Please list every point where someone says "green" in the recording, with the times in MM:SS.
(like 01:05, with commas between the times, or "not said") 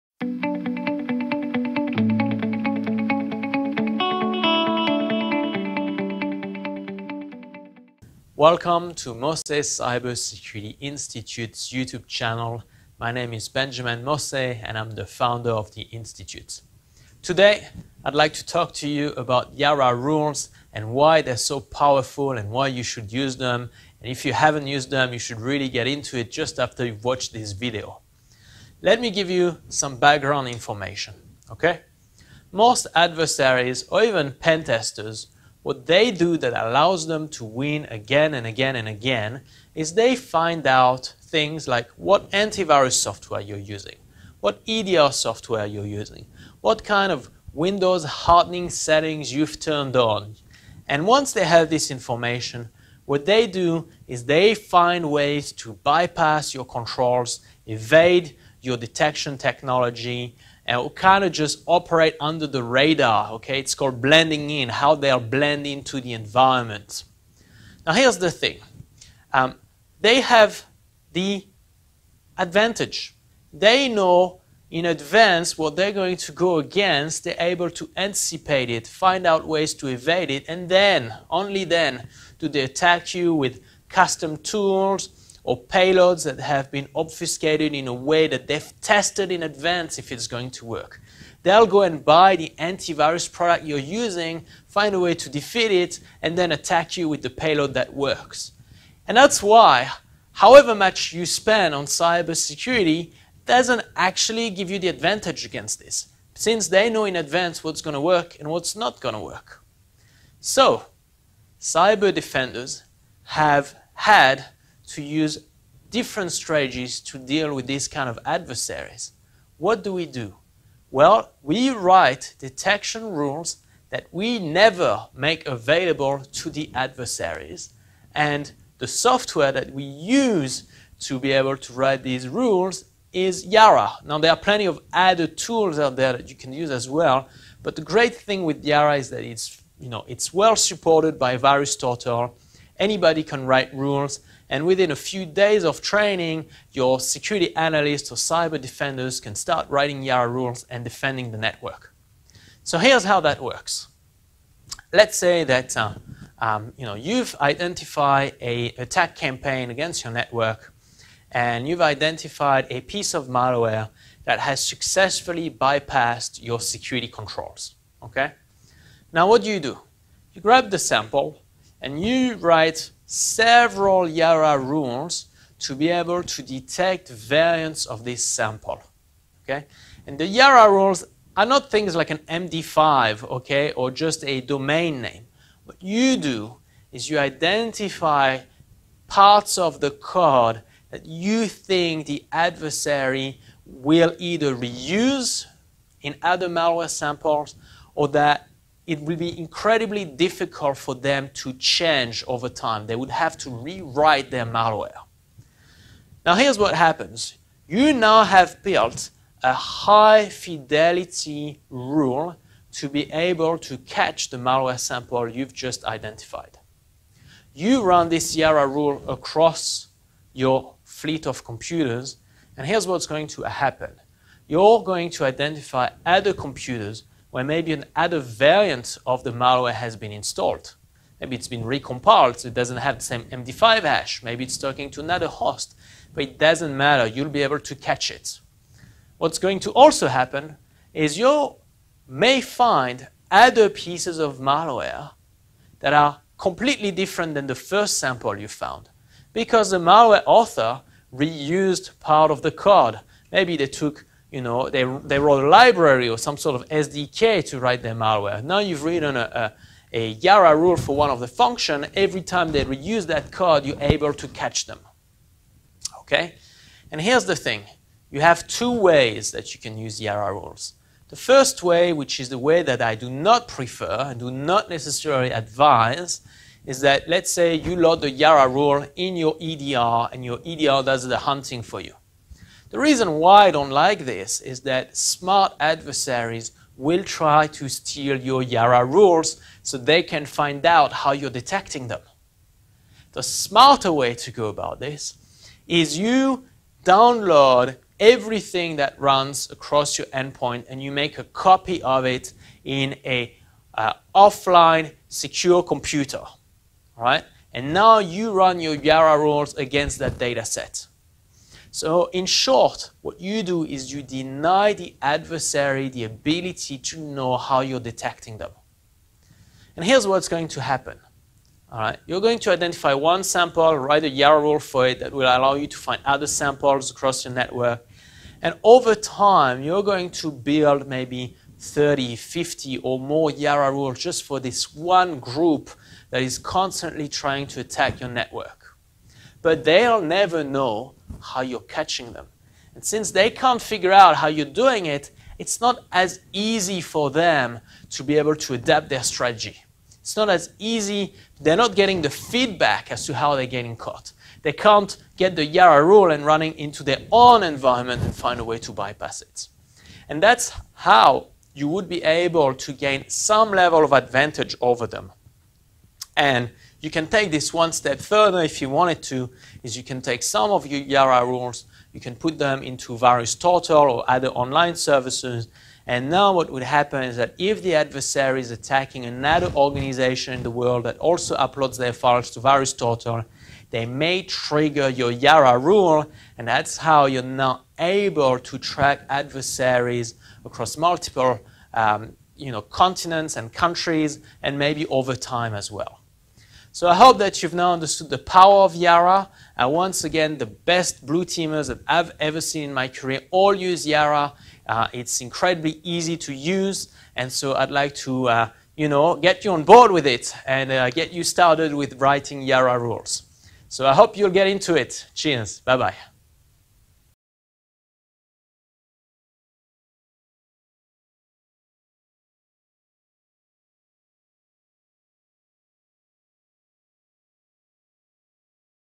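not said.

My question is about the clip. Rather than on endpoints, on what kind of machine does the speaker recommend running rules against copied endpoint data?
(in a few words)
Offline secure computer.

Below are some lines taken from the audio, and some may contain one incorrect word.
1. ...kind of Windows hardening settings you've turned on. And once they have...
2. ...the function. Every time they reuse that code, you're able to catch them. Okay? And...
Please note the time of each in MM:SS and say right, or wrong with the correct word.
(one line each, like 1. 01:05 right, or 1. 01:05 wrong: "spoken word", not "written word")
1. 00:46 right
2. 04:21 right.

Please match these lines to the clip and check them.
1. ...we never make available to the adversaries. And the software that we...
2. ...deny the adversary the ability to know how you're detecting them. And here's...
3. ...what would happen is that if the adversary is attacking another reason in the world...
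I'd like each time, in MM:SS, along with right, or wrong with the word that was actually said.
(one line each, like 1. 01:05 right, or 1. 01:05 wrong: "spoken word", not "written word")
1. 02:04 right
2. 05:14 right
3. 06:16 wrong: "organization", not "reason".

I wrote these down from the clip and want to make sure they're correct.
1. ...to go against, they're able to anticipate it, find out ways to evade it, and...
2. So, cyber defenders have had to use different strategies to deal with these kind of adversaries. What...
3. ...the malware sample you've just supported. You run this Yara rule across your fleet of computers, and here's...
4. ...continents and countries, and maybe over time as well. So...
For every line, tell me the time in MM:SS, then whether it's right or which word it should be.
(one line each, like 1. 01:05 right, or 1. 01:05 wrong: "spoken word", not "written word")
1. 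01:16 right
2. 01:50 right
3. 03:34 wrong: "identified", not "supported"
4. 06:32 right.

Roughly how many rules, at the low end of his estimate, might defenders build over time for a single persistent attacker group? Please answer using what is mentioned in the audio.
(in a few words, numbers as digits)
30.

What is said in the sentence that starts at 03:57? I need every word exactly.
You'll be able to catch it.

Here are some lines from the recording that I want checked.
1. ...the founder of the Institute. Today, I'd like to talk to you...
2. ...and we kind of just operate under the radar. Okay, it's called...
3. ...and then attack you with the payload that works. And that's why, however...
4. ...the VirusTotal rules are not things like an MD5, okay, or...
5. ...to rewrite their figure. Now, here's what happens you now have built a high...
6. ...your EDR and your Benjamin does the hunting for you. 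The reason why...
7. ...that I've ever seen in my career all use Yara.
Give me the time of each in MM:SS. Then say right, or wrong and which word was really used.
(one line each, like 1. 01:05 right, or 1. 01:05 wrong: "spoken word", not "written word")
1. 00:14 right
2. 01:00 right
3. 01:36 right
4. 03:00 wrong: "Yara", not "VirusTotal"
5. 03:23 wrong: "malware", not "figure"
6. 04:39 wrong: "EDR", not "Benjamin"
7. 06:41 right.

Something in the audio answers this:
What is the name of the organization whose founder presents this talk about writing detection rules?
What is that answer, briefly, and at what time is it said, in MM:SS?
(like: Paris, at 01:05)
Mossé Cybersecurity Institute, at 00:09.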